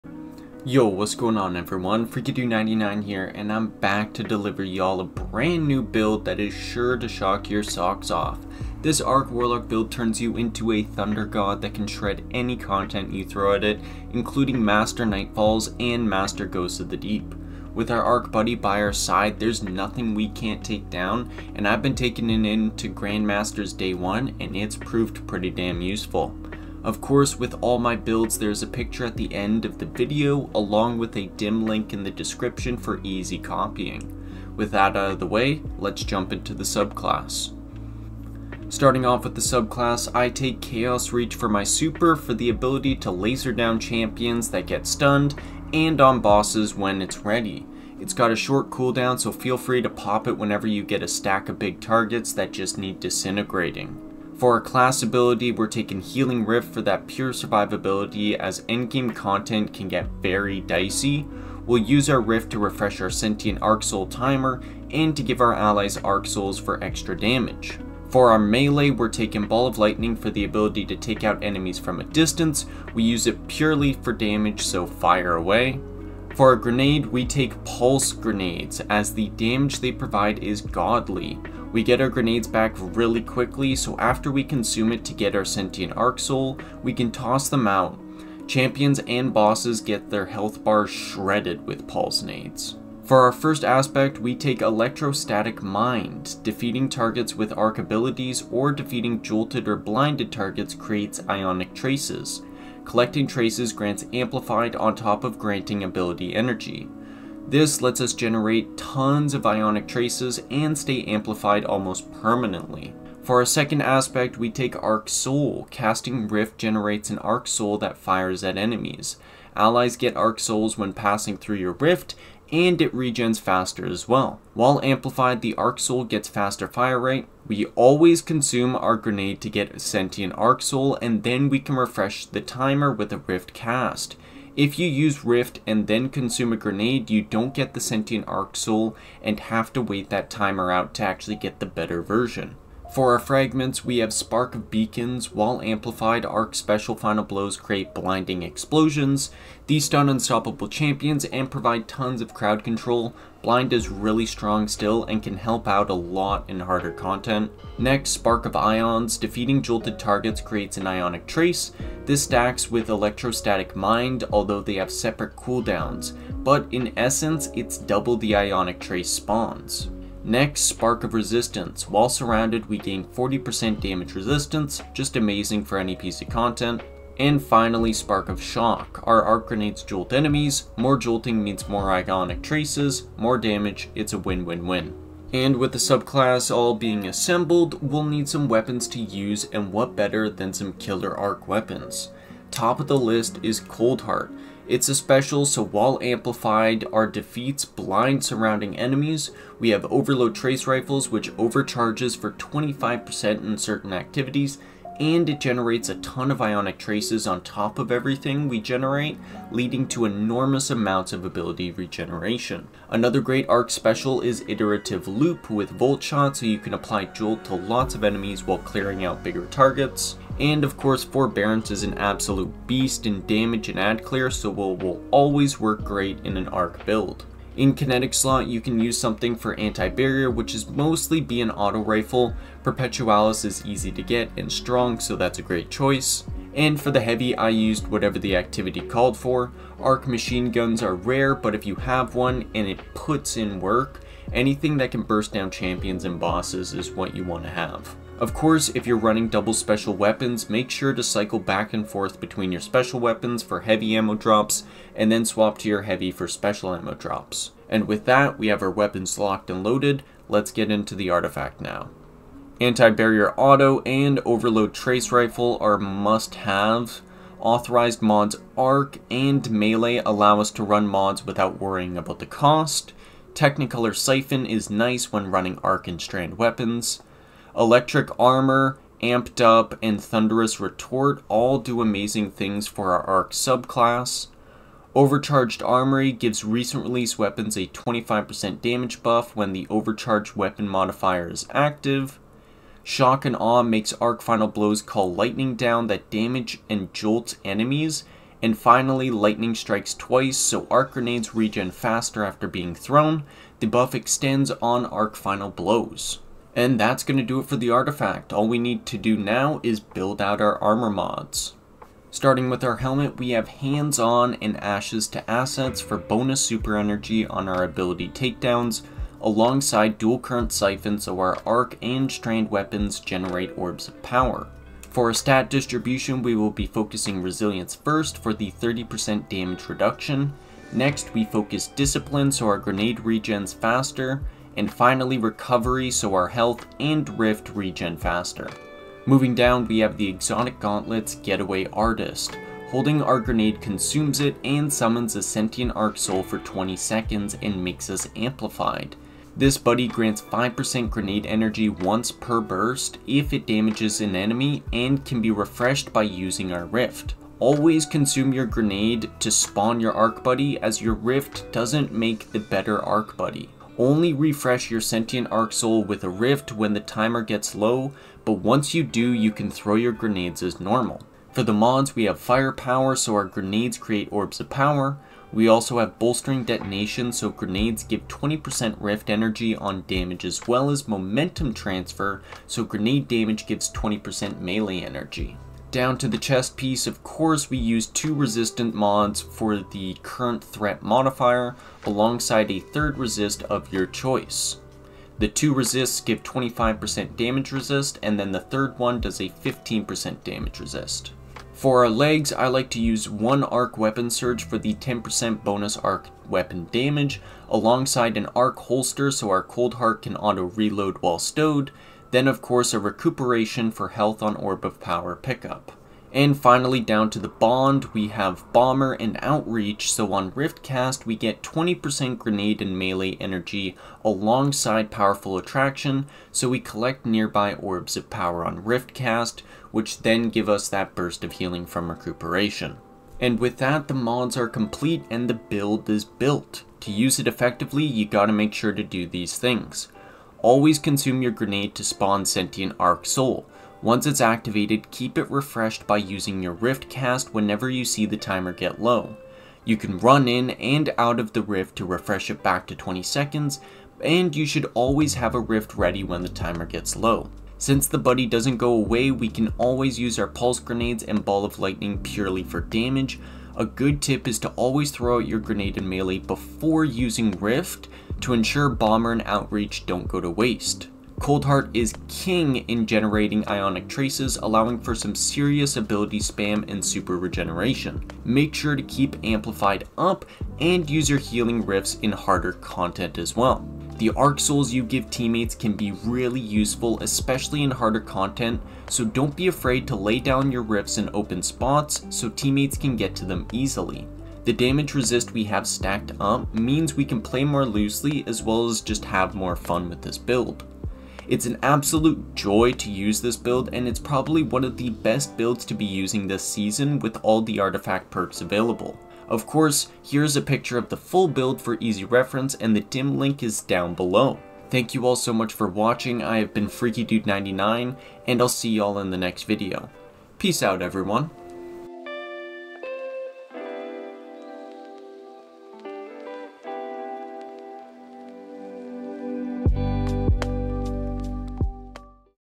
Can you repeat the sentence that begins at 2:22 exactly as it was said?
For our fragments, we have Spark of Beacons, while amplified, Arc Special Final Blows create blinding explosions.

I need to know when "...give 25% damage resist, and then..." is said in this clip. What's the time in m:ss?
6:36.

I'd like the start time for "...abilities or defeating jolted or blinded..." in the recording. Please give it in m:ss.
1:37.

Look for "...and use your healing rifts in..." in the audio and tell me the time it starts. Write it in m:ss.
8:00.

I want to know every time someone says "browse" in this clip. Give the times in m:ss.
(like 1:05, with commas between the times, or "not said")
not said.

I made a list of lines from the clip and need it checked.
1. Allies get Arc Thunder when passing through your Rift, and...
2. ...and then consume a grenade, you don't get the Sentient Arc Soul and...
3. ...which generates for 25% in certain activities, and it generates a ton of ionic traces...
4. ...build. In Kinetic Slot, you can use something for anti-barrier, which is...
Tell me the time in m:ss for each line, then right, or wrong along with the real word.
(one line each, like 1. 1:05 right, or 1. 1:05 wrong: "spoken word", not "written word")
1. 1:59 wrong: "Souls", not "Thunder"
2. 2:15 right
3. 3:21 wrong: "overcharges", not "generates"
4. 3:46 right.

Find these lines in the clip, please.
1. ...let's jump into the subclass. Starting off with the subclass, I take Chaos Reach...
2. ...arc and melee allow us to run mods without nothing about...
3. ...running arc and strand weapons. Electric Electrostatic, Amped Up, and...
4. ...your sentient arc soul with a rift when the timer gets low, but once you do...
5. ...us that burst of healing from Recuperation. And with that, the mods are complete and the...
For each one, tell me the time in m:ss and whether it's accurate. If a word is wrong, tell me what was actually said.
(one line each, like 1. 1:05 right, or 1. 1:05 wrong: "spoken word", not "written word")
1. 0:35 right
2. 4:28 wrong: "worrying", not "nothing"
3. 4:35 wrong: "Armor", not "Electrostatic"
4. 6:04 right
5. 7:10 right.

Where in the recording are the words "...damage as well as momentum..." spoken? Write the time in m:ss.
6:19.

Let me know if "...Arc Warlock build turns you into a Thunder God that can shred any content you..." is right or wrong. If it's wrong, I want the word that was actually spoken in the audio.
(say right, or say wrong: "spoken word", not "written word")
right.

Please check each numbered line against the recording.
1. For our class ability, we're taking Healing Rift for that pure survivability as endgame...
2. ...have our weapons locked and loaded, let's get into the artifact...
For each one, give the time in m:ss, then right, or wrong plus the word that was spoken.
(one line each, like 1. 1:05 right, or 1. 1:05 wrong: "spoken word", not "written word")
1. 0:54 right
2. 4:18 right.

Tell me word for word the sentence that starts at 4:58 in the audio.
And finally, lightning strikes twice, so arc grenades regen faster after being thrown.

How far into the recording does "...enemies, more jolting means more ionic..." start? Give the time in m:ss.
3:00.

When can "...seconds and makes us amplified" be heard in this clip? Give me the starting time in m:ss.
5:46.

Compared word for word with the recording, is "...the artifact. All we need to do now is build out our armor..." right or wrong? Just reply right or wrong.
right.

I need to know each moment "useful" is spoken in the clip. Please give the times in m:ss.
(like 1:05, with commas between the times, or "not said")
0:25, 8:06.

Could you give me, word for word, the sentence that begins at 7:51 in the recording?
Coldheart is king in generating ionic traces, allowing for some serious ability spam and super regeneration.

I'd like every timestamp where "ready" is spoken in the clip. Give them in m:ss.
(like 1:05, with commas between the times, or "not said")
0:47, 7:35.